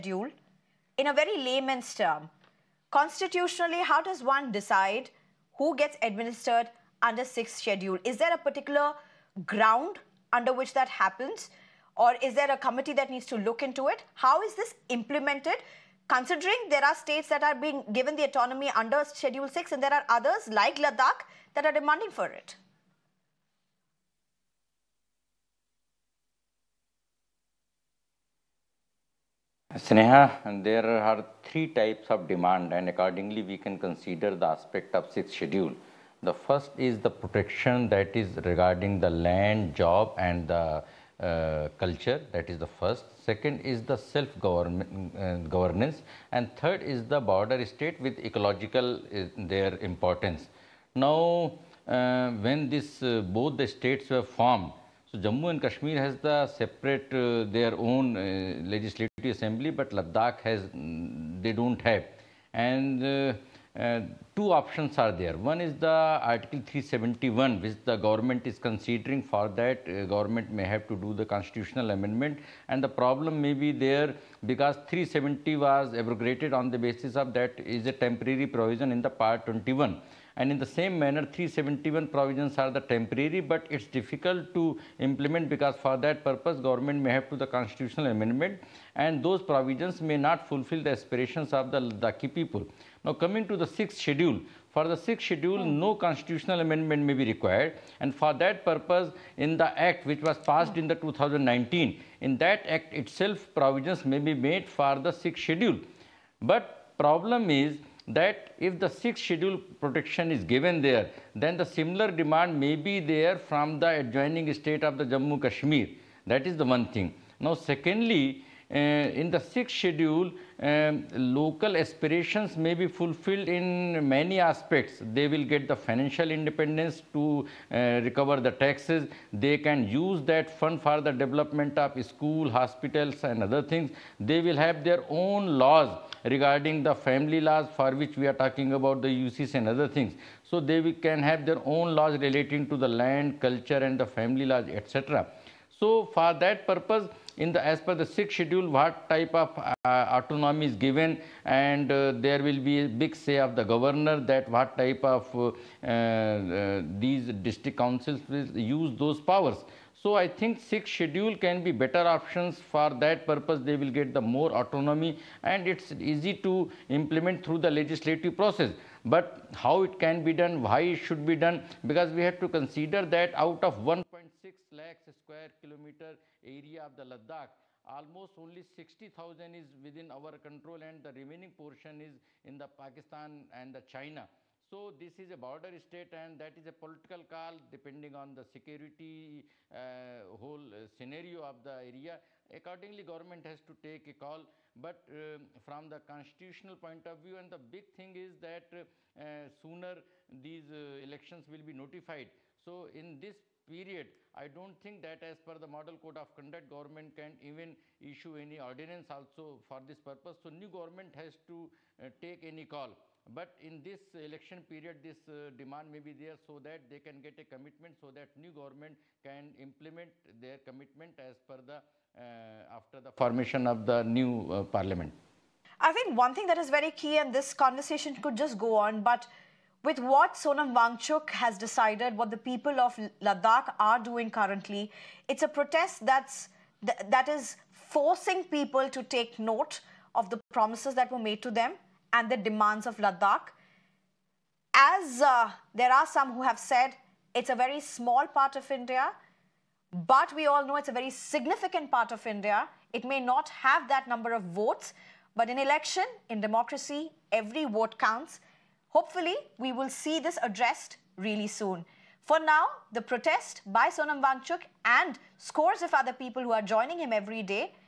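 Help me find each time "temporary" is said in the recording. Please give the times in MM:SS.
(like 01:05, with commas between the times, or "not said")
01:17, 01:22.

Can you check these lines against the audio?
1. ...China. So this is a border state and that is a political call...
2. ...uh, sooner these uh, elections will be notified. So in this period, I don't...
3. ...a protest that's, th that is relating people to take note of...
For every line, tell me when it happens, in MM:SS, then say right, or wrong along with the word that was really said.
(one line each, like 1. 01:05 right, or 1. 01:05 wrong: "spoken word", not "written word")
1. 03:03 right
2. 03:18 right
3. 03:55 wrong: "forcing", not "relating".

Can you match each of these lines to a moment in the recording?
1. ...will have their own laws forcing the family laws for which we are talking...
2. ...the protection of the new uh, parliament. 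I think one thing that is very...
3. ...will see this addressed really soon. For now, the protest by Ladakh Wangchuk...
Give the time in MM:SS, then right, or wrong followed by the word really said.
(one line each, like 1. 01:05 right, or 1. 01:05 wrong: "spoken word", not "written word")
1. 02:14 wrong: "regarding", not "forcing"
2. 03:42 wrong: "formation", not "protection"
3. 04:19 wrong: "Sonam", not "Ladakh".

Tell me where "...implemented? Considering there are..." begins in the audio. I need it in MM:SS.
00:14.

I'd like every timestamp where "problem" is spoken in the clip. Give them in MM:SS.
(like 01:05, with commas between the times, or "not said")
01:12, 01:46.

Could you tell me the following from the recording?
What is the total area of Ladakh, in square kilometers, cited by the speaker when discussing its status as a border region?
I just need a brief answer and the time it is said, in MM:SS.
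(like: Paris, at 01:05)
1.6 lakh, at 02:53.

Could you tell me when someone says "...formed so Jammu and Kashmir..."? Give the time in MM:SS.
00:54.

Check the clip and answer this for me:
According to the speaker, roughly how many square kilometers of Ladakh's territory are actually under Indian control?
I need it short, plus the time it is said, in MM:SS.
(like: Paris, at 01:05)
60,000, at 02:58.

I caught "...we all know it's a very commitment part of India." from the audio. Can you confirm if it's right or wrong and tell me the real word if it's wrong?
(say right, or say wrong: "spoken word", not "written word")
wrong: "significant", not "commitment".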